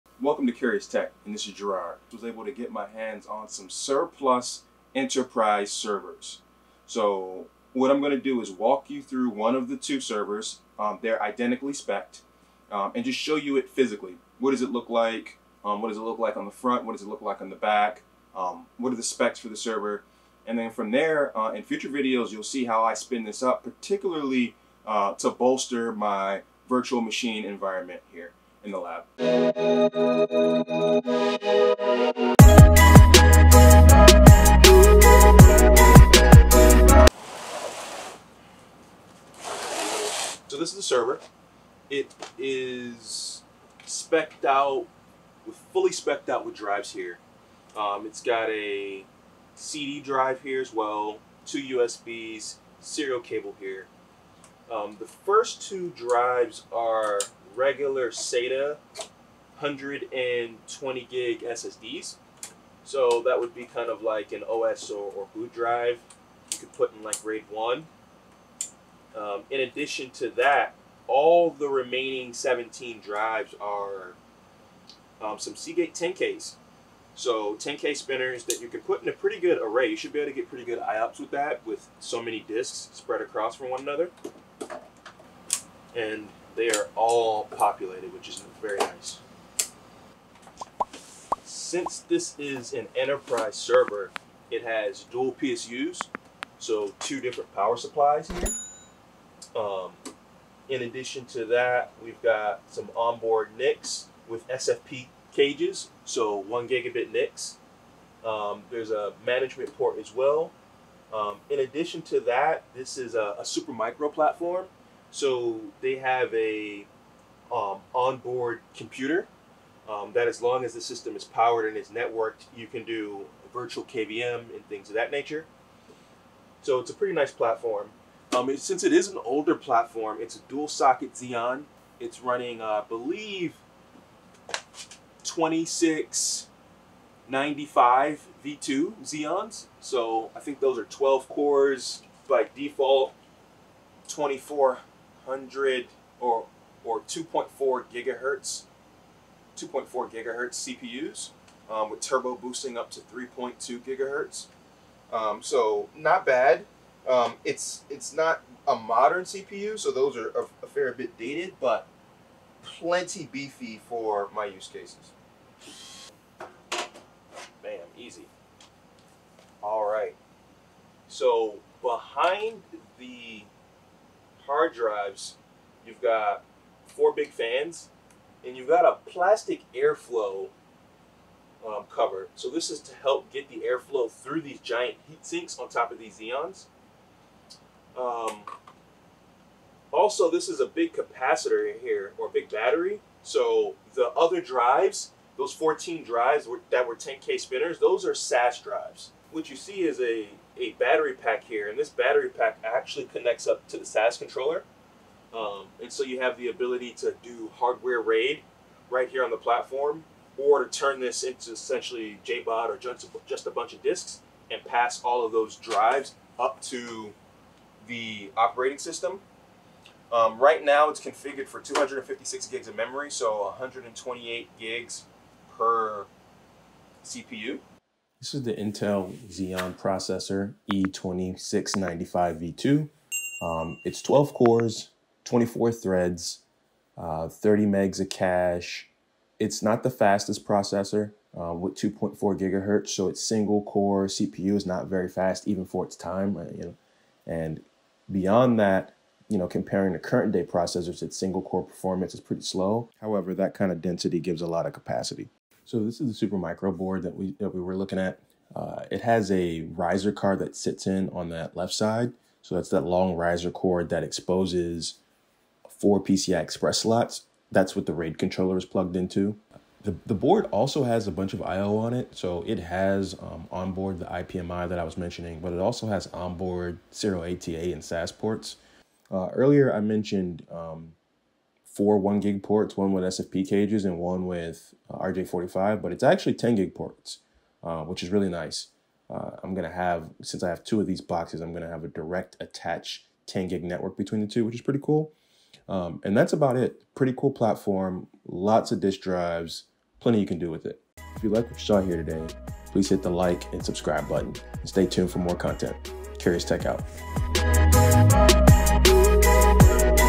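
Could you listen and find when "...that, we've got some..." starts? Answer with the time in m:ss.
1:41.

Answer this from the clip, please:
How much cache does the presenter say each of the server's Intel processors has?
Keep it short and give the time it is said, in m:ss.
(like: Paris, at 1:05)
30 MB, at 3:57.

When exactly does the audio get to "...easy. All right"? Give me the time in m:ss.
2:47.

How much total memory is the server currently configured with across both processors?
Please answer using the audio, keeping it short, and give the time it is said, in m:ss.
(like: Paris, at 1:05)
256 GB, at 3:41.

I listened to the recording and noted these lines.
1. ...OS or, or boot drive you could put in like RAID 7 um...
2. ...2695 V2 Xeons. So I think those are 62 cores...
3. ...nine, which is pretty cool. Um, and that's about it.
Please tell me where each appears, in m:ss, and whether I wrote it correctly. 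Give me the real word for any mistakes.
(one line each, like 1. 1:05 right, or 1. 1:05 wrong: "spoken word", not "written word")
1. 1:04 wrong: "1", not "7"
2. 2:15 wrong: "12", not "62"
3. 4:54 wrong: "two", not "nine".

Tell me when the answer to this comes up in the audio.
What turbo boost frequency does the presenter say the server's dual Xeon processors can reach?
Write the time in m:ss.
2:33.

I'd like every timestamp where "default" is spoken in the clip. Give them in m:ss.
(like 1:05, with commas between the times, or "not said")
2:22.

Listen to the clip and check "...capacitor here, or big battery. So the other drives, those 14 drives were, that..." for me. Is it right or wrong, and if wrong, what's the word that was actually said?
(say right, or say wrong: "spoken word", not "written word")
right.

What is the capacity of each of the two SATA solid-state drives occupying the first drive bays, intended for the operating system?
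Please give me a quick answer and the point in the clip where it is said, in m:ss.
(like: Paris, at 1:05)
120 GB, at 0:59.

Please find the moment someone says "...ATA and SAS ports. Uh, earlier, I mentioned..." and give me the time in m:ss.
4:37.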